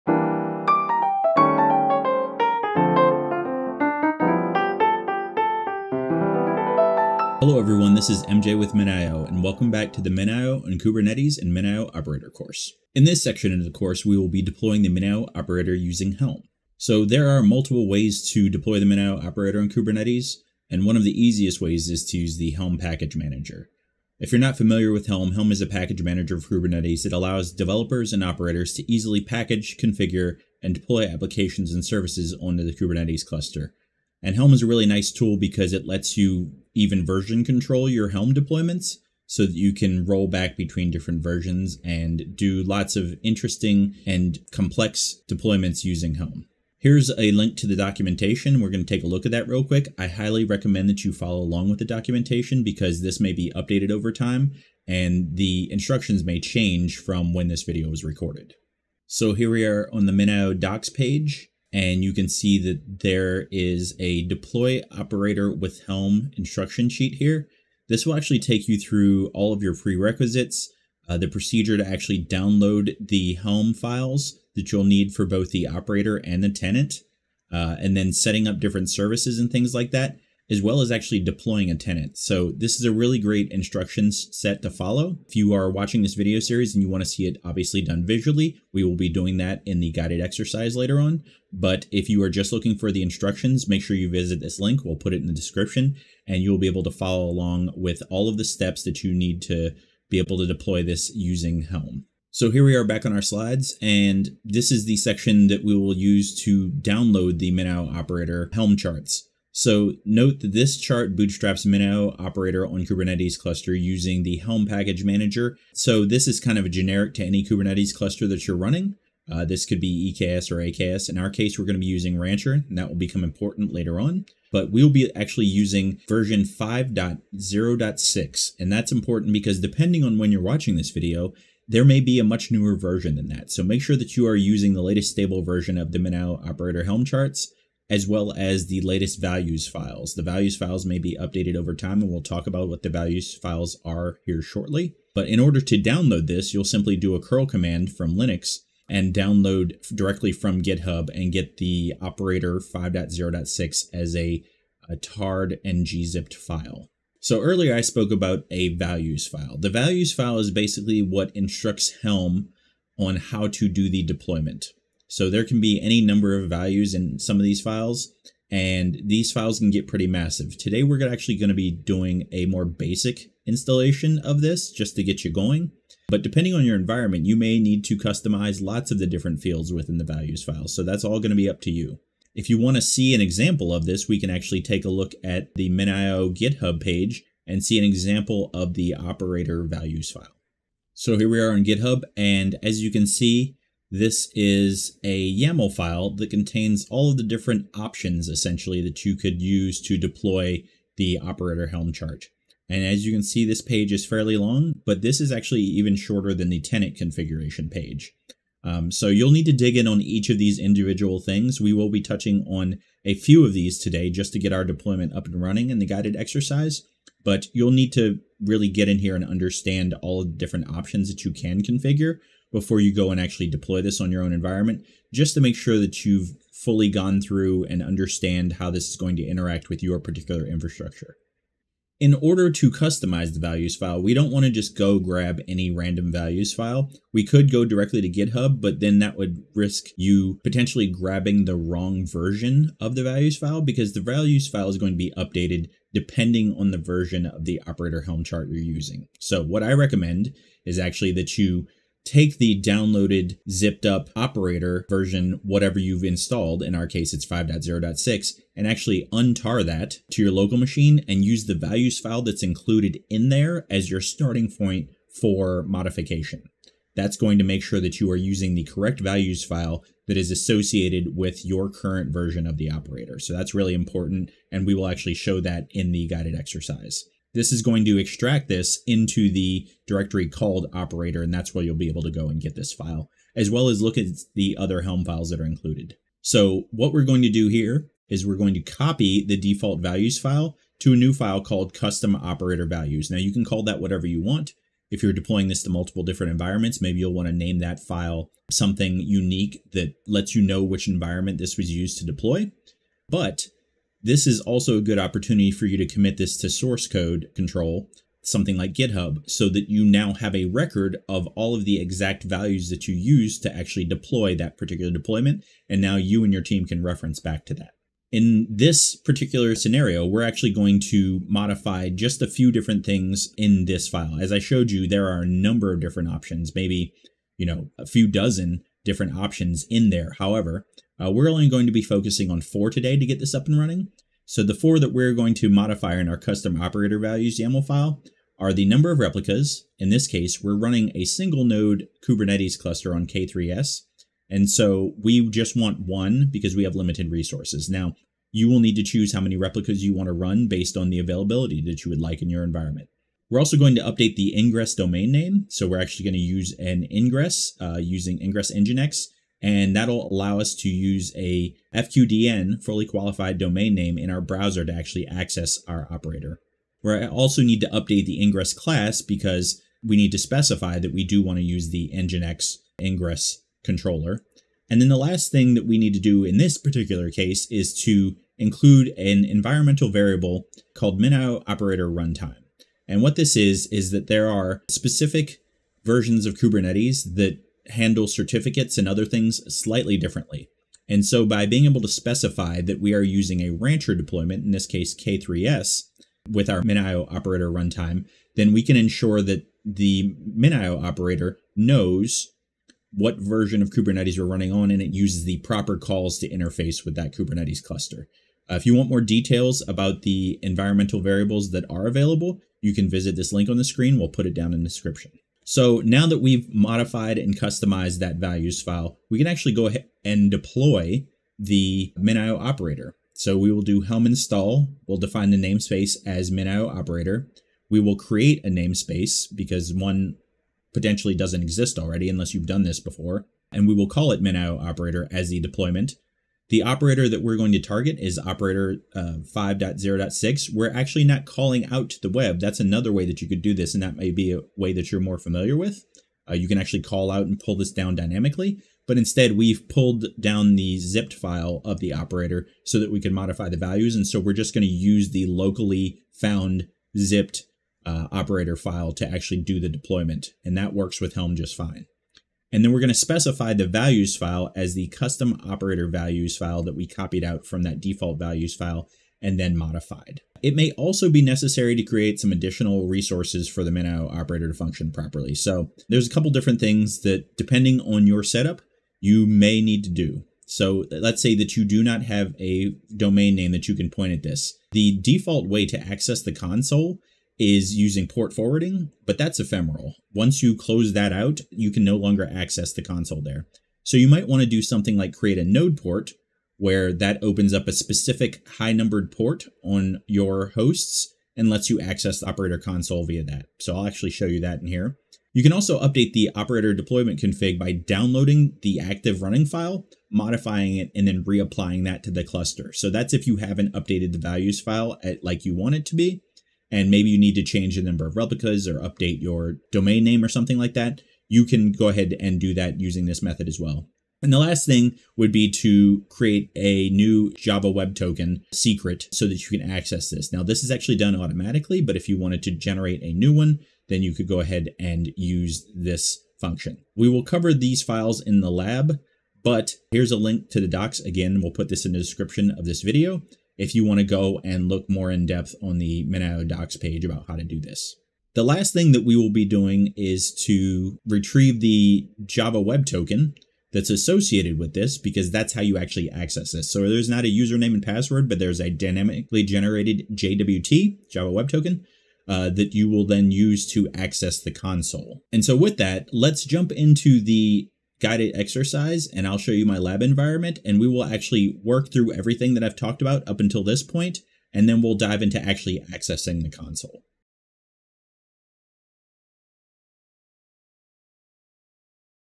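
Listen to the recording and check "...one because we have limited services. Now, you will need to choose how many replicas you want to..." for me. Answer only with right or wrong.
wrong.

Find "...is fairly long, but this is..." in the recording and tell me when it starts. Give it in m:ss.
3:23.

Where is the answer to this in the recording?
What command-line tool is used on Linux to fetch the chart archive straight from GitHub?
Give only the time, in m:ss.
2:27.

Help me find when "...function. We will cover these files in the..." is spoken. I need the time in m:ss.
8:56.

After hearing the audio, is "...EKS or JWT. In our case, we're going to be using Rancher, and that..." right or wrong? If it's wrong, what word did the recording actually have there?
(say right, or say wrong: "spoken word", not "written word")
wrong: "AKS", not "JWT".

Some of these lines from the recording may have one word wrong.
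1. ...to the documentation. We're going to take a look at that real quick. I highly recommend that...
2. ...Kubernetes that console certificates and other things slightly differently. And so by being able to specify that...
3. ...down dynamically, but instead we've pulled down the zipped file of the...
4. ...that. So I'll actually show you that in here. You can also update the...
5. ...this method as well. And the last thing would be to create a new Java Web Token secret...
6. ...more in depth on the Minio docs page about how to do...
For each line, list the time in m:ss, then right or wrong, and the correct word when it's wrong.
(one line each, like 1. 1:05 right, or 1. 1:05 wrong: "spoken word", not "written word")
1. 0:47 right
2. 6:26 wrong: "handle", not "console"
3. 7:27 right
4. 8:23 right
5. 8:43 right
6. 9:04 right.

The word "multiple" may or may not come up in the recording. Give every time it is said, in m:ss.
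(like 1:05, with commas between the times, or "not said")
0:17, 4:55.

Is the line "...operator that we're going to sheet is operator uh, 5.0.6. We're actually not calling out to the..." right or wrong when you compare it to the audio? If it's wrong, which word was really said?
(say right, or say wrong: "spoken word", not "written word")
wrong: "target", not "sheet".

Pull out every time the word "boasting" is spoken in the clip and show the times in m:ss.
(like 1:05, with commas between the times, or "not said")
not said.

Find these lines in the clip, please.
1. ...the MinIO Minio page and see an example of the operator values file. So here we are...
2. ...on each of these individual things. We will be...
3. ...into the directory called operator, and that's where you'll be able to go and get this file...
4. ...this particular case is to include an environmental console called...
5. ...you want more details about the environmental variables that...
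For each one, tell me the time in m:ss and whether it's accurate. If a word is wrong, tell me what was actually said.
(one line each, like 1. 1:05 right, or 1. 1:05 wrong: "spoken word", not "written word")
1. 3:05 wrong: "GitHub", not "Minio"
2. 3:29 right
3. 4:38 right
4. 6:16 wrong: "variable", not "console"
5. 6:48 right.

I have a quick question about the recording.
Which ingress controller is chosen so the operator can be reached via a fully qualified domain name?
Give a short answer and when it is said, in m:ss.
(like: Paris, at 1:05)
ingress nginx, at 5:58.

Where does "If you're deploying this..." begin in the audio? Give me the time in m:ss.
4:54.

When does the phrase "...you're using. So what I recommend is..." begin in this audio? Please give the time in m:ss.
4:08.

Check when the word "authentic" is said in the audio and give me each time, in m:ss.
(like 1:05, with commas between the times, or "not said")
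not said.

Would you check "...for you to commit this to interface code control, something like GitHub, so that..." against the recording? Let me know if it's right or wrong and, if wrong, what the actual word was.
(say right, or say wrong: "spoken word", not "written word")
wrong: "source", not "interface".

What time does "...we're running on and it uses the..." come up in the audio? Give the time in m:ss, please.
6:44.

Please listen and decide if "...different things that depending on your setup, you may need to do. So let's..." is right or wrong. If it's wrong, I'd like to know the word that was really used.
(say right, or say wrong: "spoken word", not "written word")
right.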